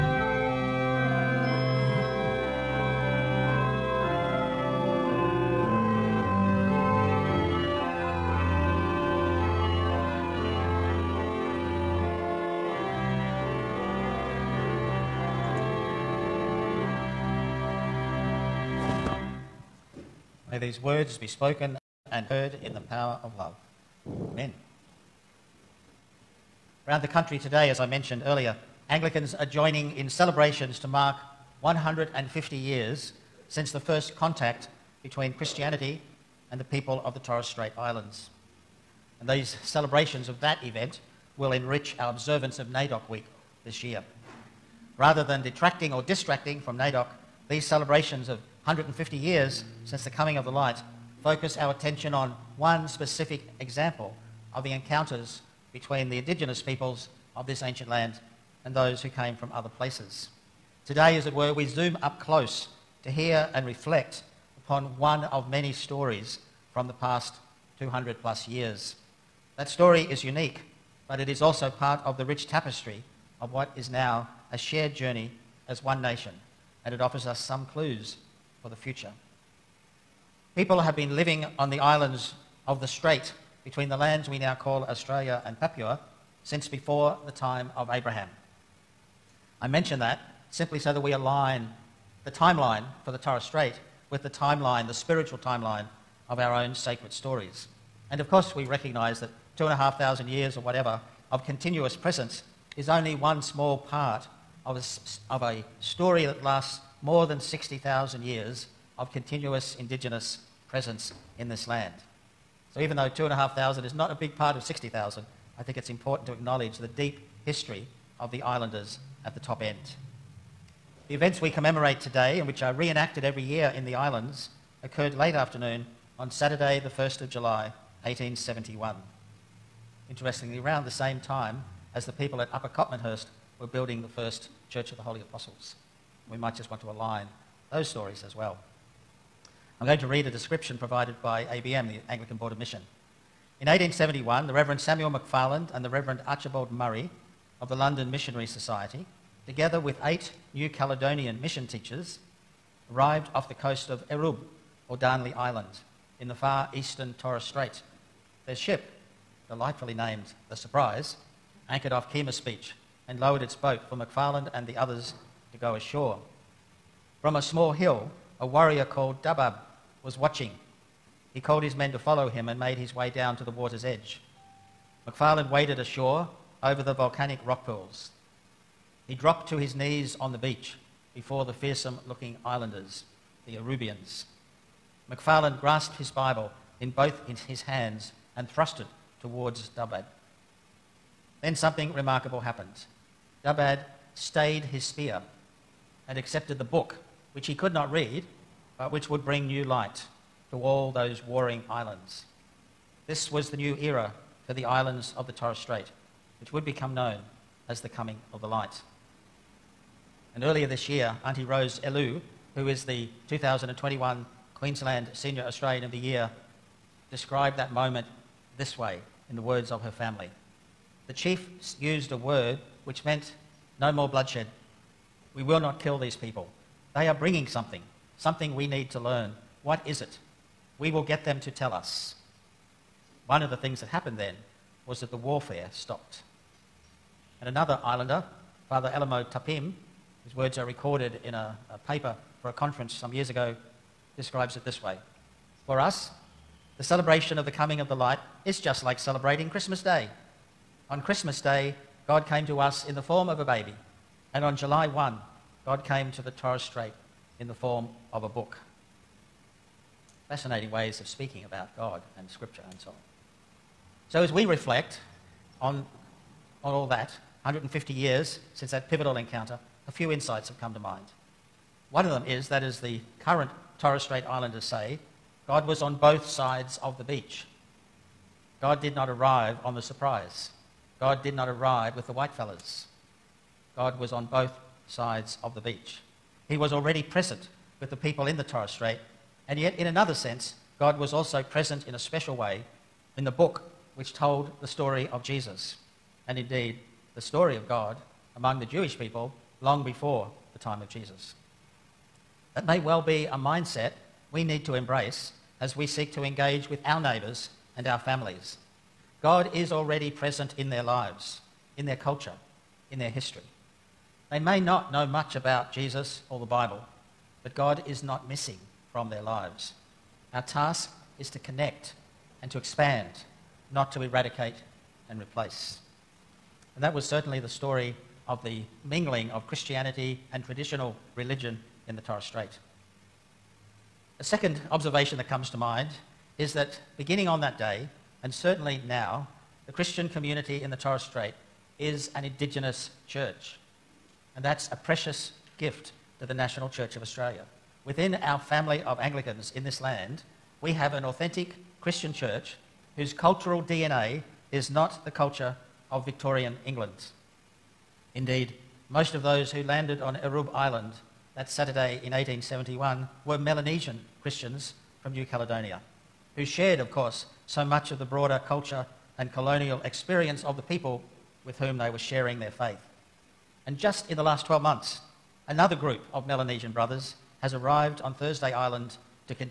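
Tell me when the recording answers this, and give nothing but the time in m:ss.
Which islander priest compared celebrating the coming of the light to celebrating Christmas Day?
3:58.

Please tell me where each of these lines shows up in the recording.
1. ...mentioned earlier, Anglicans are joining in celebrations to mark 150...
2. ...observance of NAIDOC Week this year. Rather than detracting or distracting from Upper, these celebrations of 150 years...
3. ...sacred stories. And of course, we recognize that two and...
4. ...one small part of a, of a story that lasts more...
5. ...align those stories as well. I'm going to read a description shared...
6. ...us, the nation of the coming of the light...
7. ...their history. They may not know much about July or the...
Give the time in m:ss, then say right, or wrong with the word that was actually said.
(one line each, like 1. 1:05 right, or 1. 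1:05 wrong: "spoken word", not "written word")
1. 0:27 right
2. 0:42 wrong: "NAIDOC", not "Upper"
3. 1:36 right
4. 1:43 right
5. 2:16 wrong: "provided", not "shared"
6. 4:05 wrong: "celebration", not "nation"
7. 5:12 wrong: "Jesus", not "July".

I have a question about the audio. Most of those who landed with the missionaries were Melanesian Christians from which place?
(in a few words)
New Caledonia.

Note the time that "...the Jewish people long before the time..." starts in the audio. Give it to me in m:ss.
4:58.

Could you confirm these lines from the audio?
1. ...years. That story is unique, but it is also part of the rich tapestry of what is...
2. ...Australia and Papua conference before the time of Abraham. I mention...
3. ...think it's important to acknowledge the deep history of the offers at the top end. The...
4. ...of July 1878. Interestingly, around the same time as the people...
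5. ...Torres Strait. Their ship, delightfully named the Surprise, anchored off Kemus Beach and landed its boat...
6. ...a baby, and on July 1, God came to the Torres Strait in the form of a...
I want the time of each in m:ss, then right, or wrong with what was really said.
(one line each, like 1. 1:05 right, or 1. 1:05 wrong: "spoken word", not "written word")
1. 1:08 right
2. 1:24 wrong: "since", not "conference"
3. 1:55 wrong: "islanders", not "offers"
4. 2:07 wrong: "1871", not "1878"
5. 2:37 wrong: "lowered", not "landed"
6. 4:13 right.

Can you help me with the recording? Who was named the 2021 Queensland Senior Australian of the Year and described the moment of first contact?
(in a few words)
Auntie Rose Elu.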